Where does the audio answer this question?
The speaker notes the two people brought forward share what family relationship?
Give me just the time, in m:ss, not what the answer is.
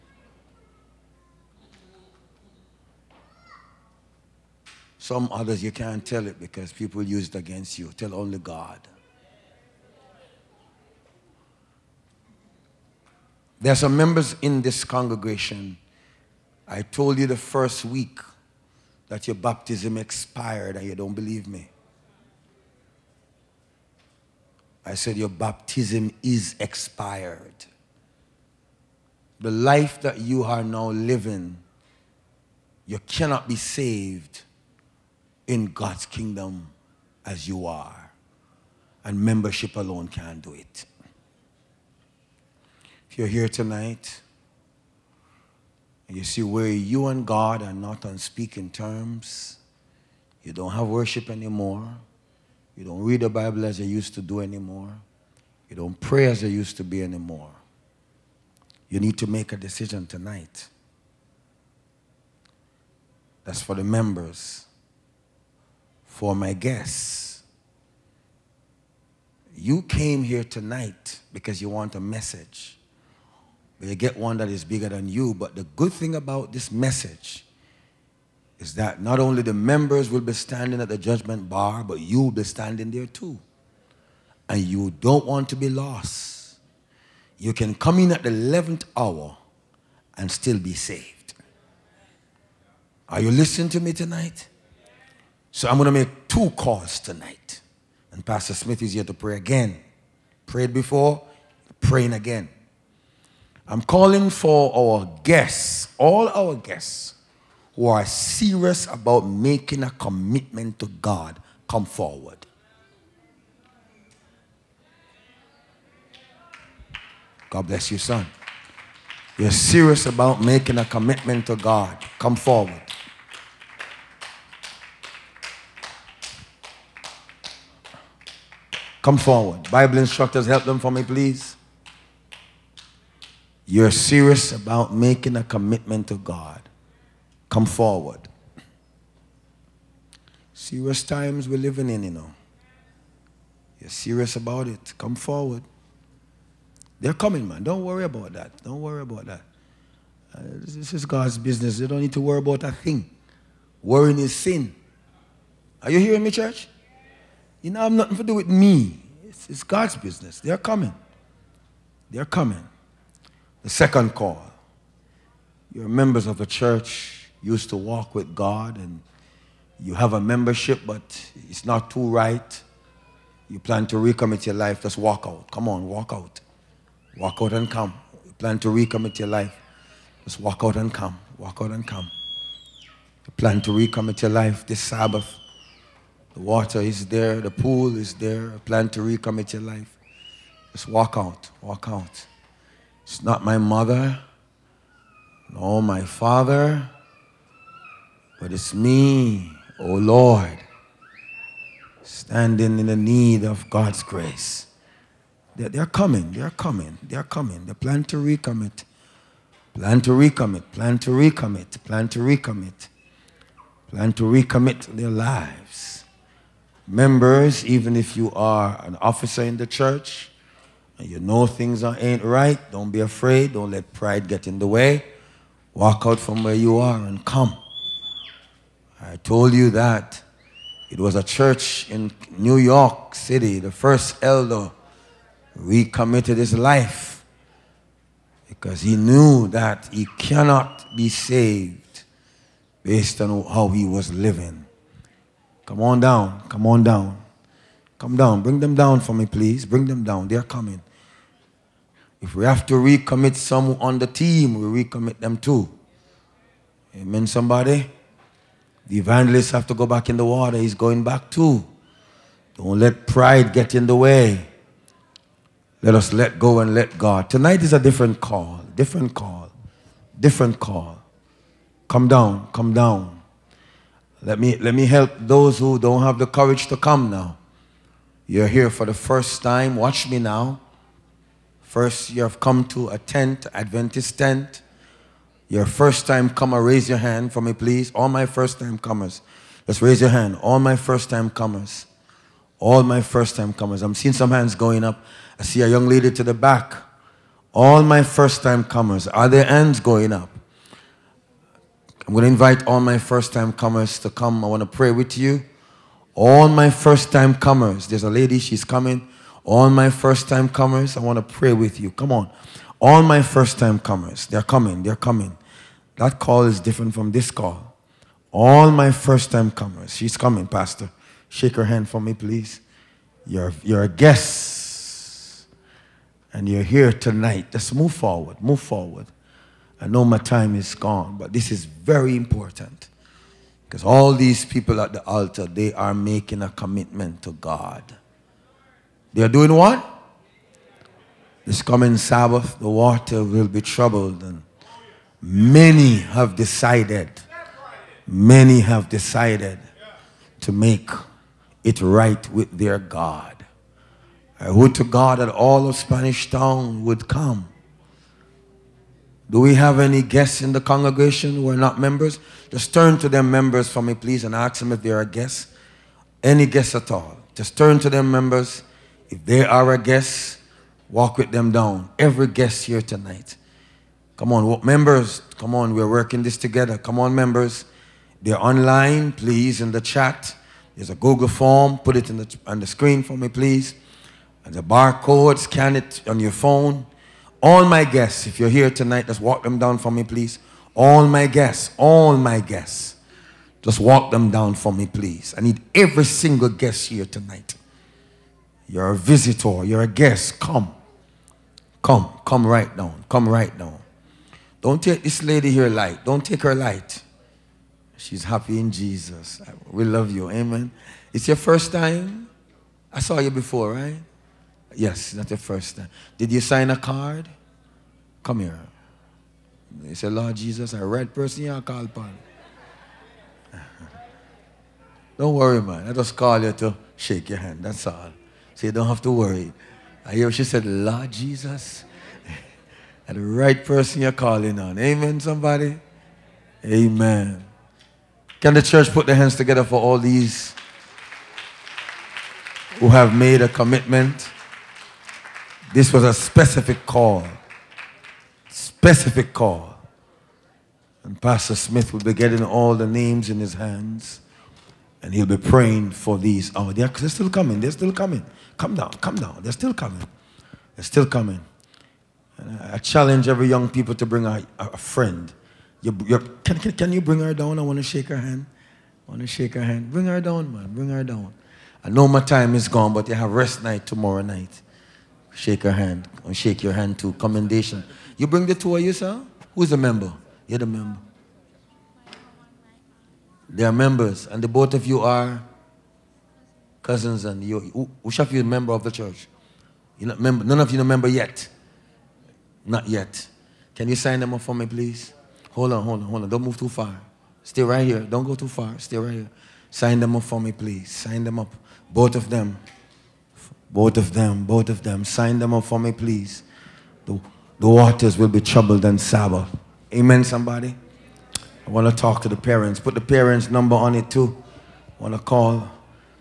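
8:06.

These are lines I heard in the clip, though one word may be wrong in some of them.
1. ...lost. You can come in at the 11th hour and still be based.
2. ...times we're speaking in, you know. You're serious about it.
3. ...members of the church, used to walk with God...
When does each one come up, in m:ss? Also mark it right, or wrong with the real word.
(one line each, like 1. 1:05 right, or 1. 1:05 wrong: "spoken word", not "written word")
1. 1:25 wrong: "saved", not "based"
2. 2:21 wrong: "living", not "speaking"
3. 2:45 right.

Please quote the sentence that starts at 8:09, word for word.
You're not member, none of you are a member yet.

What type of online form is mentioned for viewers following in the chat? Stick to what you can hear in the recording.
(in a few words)
Google form.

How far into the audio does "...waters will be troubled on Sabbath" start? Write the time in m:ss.
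8:27.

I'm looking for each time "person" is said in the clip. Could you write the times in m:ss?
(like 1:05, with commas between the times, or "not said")
7:01, 7:13.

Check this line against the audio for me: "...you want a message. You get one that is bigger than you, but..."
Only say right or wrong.
right.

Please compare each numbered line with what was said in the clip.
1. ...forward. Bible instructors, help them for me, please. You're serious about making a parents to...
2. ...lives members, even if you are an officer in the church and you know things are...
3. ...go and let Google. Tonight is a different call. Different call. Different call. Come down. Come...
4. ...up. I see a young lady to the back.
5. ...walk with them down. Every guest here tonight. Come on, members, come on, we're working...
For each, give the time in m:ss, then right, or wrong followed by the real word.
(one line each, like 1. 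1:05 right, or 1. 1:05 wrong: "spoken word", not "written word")
1. 2:09 wrong: "commitment", not "parents"
2. 3:35 right
3. 4:26 wrong: "God", not "Google"
4. 4:54 right
5. 6:10 right.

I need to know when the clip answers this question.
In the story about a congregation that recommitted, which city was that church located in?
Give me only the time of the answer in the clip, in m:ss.
3:52.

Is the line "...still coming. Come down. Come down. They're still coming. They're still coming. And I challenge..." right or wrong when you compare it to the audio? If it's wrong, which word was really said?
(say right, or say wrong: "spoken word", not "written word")
right.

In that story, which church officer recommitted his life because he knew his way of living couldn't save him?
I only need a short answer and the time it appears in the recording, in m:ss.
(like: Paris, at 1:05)
The first elder, at 3:53.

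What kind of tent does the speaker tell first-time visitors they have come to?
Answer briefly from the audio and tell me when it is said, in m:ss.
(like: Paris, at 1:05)
Adventist tent, at 4:43.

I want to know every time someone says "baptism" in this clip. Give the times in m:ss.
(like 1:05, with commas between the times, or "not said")
0:19, 0:25.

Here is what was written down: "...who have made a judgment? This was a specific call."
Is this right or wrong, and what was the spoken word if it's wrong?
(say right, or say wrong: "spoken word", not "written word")
wrong: "commitment", not "judgment".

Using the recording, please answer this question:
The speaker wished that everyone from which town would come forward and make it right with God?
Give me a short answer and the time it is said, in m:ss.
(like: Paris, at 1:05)
Spanish Town, at 5:55.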